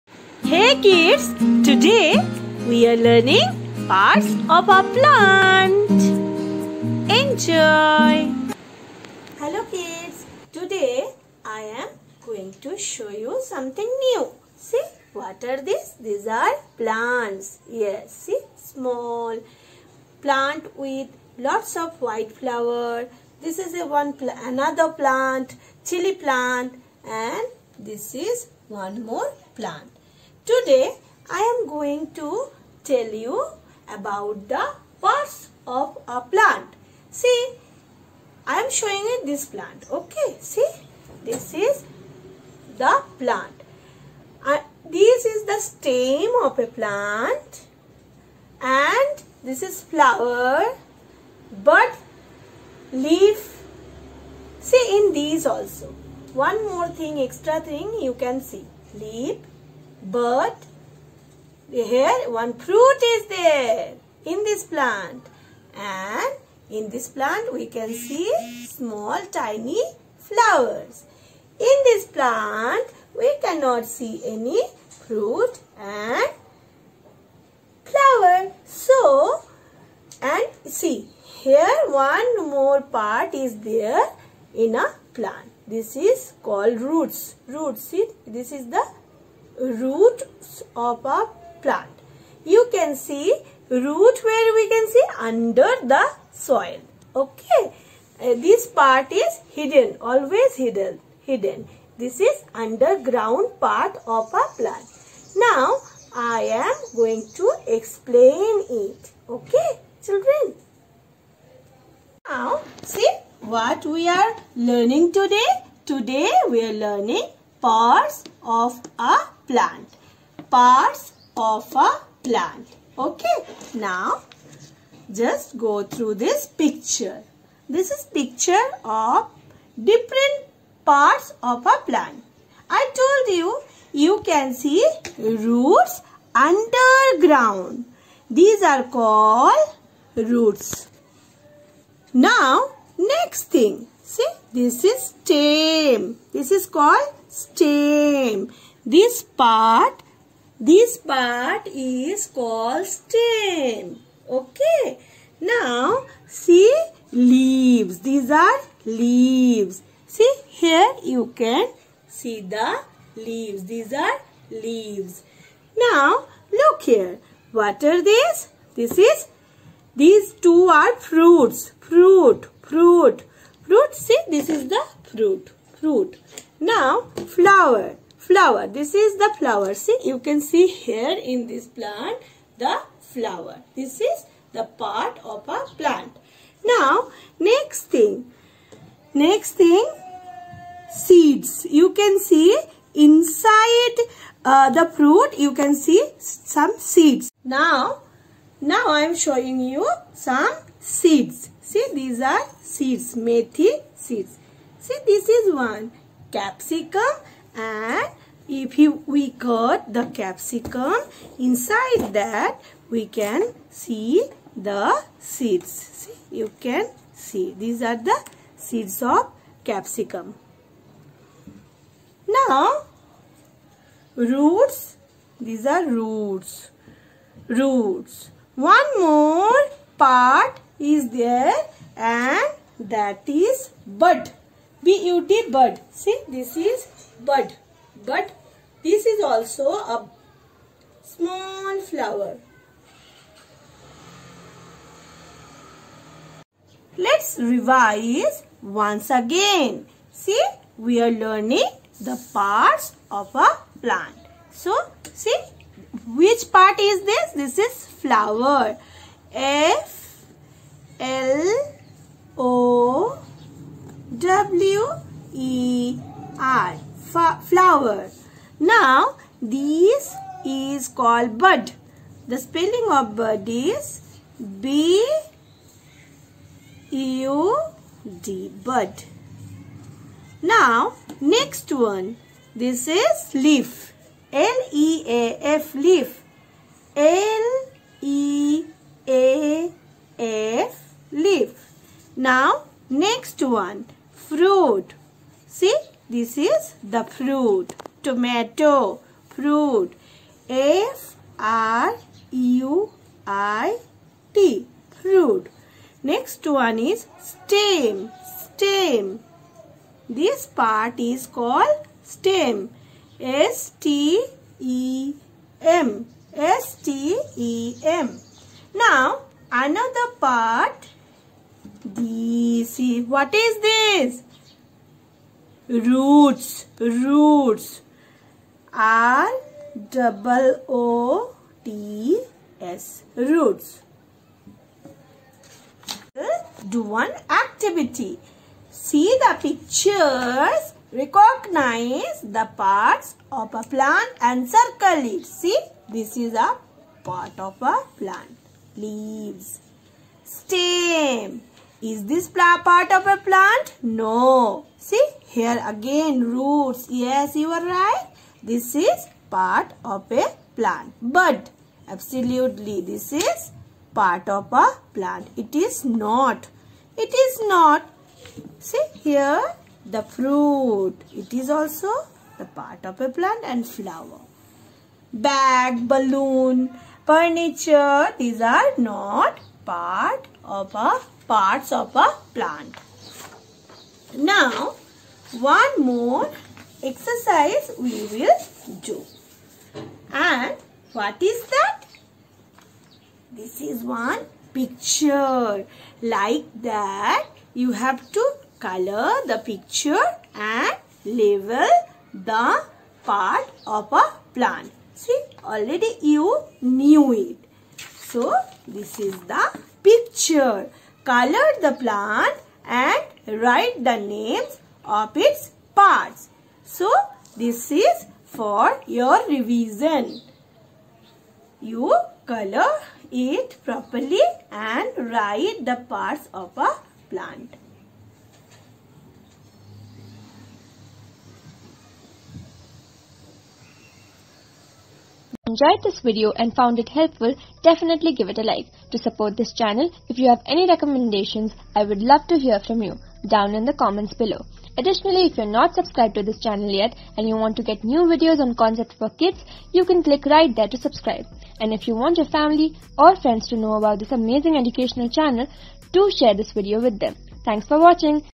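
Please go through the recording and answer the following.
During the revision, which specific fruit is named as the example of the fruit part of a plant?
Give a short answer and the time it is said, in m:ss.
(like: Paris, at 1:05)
Tomato, at 4:58.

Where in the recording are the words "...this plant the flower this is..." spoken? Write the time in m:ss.
3:01.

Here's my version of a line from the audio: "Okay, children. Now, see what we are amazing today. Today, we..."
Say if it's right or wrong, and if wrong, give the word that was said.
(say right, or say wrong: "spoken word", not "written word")
wrong: "learning", not "amazing".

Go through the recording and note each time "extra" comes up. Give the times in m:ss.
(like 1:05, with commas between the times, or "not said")
0:57.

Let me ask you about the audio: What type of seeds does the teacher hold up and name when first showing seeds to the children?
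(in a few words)
Methi seeds.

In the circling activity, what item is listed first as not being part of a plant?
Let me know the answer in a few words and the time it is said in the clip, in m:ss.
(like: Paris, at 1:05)
Bag, at 6:15.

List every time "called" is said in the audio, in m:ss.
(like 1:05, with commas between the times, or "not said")
1:26, 2:18, 2:26, 2:32, 4:30, 5:11.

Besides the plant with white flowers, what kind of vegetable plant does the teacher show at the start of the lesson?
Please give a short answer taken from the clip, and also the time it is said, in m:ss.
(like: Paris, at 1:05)
Chili plant, at 0:25.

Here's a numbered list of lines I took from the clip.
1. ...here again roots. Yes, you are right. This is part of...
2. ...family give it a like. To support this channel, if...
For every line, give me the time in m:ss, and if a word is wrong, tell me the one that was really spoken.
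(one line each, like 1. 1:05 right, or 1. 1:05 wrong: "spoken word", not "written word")
1. 5:55 right
2. 7:17 wrong: "definitely", not "family".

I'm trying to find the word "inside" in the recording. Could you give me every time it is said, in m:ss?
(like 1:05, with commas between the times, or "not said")
3:12, 3:31.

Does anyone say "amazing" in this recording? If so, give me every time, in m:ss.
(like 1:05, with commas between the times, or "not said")
7:34.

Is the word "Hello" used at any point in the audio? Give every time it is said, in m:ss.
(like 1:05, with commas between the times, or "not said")
0:09.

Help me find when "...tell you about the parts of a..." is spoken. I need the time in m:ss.
0:32.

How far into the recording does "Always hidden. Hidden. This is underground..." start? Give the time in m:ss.
1:40.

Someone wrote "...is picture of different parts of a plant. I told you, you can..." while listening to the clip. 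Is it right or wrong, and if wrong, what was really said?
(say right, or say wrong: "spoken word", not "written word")
right.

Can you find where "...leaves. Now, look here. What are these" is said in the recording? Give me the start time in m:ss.
2:44.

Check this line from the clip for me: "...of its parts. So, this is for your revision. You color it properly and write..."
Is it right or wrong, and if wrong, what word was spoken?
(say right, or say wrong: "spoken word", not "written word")
right.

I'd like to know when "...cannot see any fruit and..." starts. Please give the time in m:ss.
1:13.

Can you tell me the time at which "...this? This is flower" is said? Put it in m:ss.
4:17.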